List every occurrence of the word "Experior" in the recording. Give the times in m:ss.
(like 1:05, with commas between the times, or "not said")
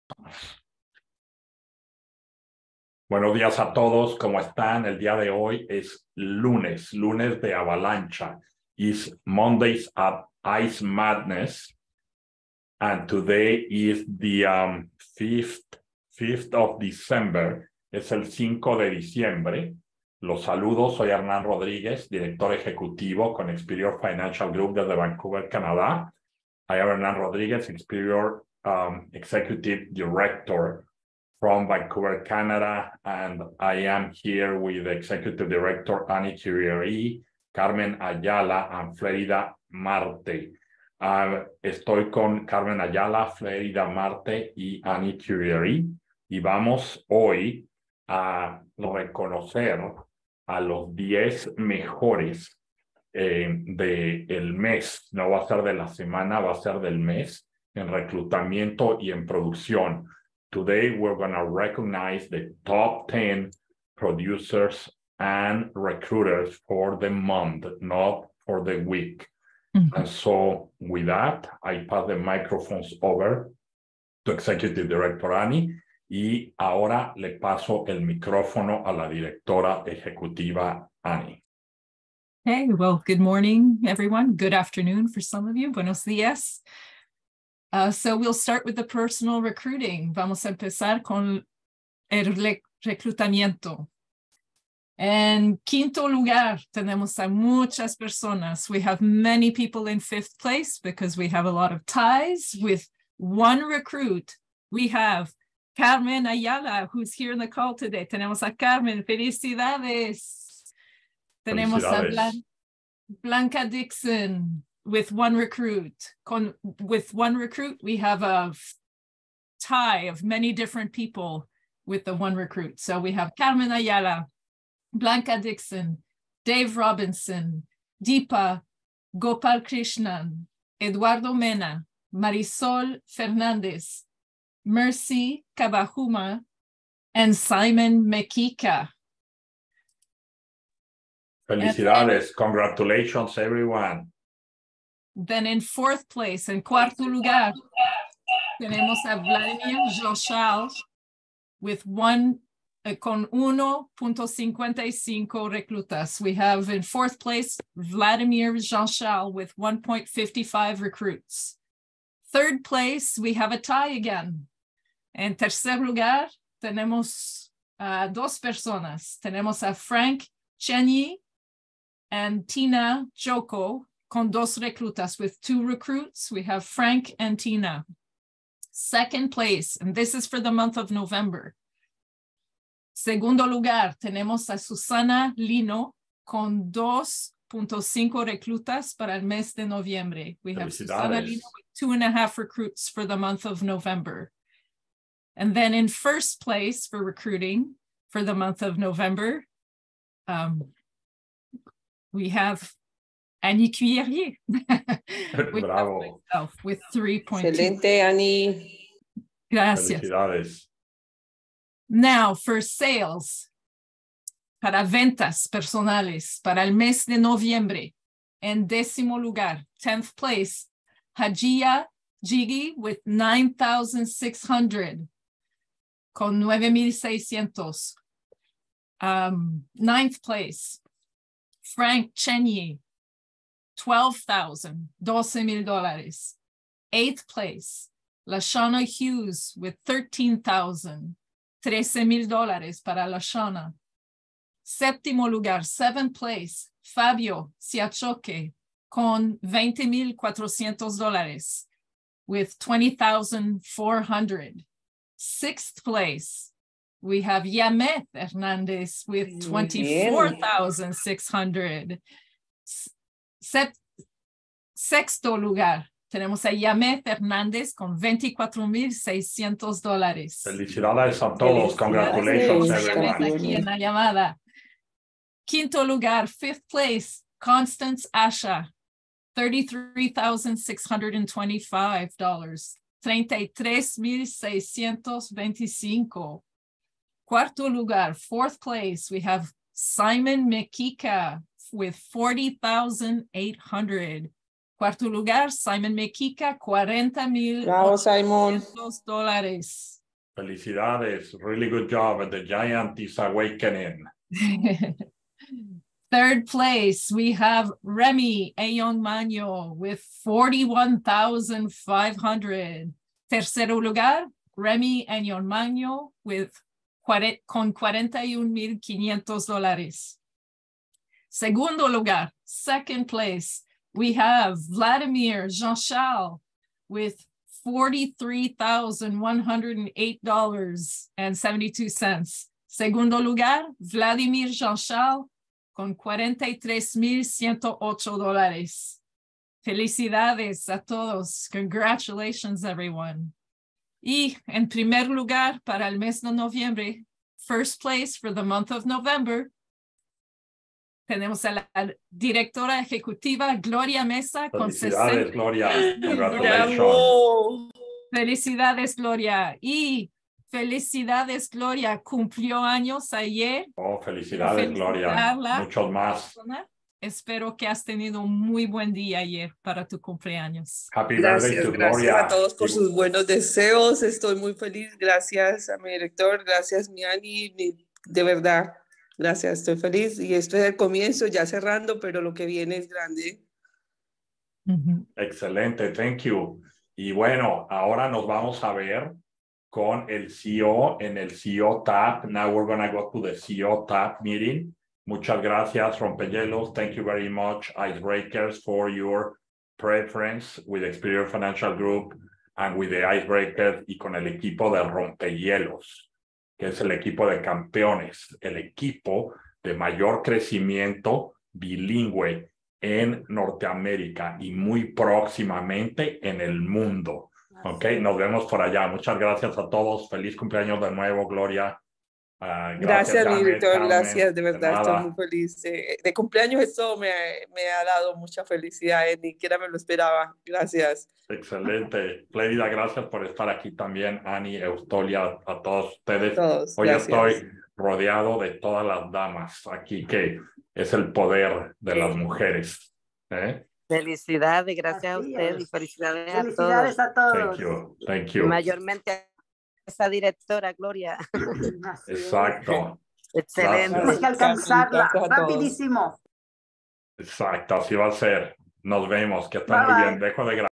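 0:23, 0:27, 6:40.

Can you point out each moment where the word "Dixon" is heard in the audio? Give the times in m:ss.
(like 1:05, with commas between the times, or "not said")
1:53, 2:05.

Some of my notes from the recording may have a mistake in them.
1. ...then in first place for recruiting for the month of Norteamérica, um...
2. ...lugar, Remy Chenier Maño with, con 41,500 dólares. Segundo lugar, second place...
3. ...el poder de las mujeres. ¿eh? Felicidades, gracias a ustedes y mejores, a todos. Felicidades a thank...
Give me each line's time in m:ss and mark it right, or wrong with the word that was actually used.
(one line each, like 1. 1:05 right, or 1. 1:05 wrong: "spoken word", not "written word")
1. 3:15 wrong: "November", not "Norteamérica"
2. 5:13 wrong: "Ayon", not "Chenier"
3. 7:20 wrong: "felicidades", not "mejores".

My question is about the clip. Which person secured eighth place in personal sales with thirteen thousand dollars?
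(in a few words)
Lashana Hughes.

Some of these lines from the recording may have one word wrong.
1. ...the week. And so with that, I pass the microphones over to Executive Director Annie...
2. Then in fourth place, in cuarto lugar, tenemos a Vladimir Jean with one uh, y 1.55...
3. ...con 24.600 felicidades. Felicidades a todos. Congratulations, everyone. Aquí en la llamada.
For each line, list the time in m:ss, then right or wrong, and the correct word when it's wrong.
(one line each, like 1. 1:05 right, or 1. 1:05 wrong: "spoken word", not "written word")
1. 1:08 right
2. 2:25 right
3. 4:27 wrong: "dólares", not "felicidades".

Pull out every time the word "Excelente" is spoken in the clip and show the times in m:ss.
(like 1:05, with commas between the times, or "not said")
3:27, 6:25, 7:11, 7:33.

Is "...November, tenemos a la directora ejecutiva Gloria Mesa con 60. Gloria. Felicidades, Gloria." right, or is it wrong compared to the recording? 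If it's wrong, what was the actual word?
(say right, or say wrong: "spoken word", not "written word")
right.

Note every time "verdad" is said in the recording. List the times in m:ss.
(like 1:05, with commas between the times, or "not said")
6:18, 7:04.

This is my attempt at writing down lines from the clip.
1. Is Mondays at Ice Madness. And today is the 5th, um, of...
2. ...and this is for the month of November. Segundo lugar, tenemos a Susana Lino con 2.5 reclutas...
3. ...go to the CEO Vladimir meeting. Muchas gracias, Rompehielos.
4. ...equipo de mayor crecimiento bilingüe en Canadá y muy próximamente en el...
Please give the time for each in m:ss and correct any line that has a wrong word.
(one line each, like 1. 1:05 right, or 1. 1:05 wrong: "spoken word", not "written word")
1. 0:08 right
2. 2:59 right
3. 6:32 wrong: "TAP", not "Vladimir"
4. 6:48 wrong: "Norteamérica", not "Canadá".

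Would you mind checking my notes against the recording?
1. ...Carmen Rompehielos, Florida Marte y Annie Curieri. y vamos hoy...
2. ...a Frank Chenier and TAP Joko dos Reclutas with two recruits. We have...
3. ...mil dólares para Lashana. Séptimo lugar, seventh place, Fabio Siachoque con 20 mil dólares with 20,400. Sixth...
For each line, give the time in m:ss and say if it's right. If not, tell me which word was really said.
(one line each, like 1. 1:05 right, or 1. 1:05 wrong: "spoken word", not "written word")
1. 0:42 wrong: "Ayala", not "Rompehielos"
2. 2:49 wrong: "Tina", not "TAP"
3. 4:02 right.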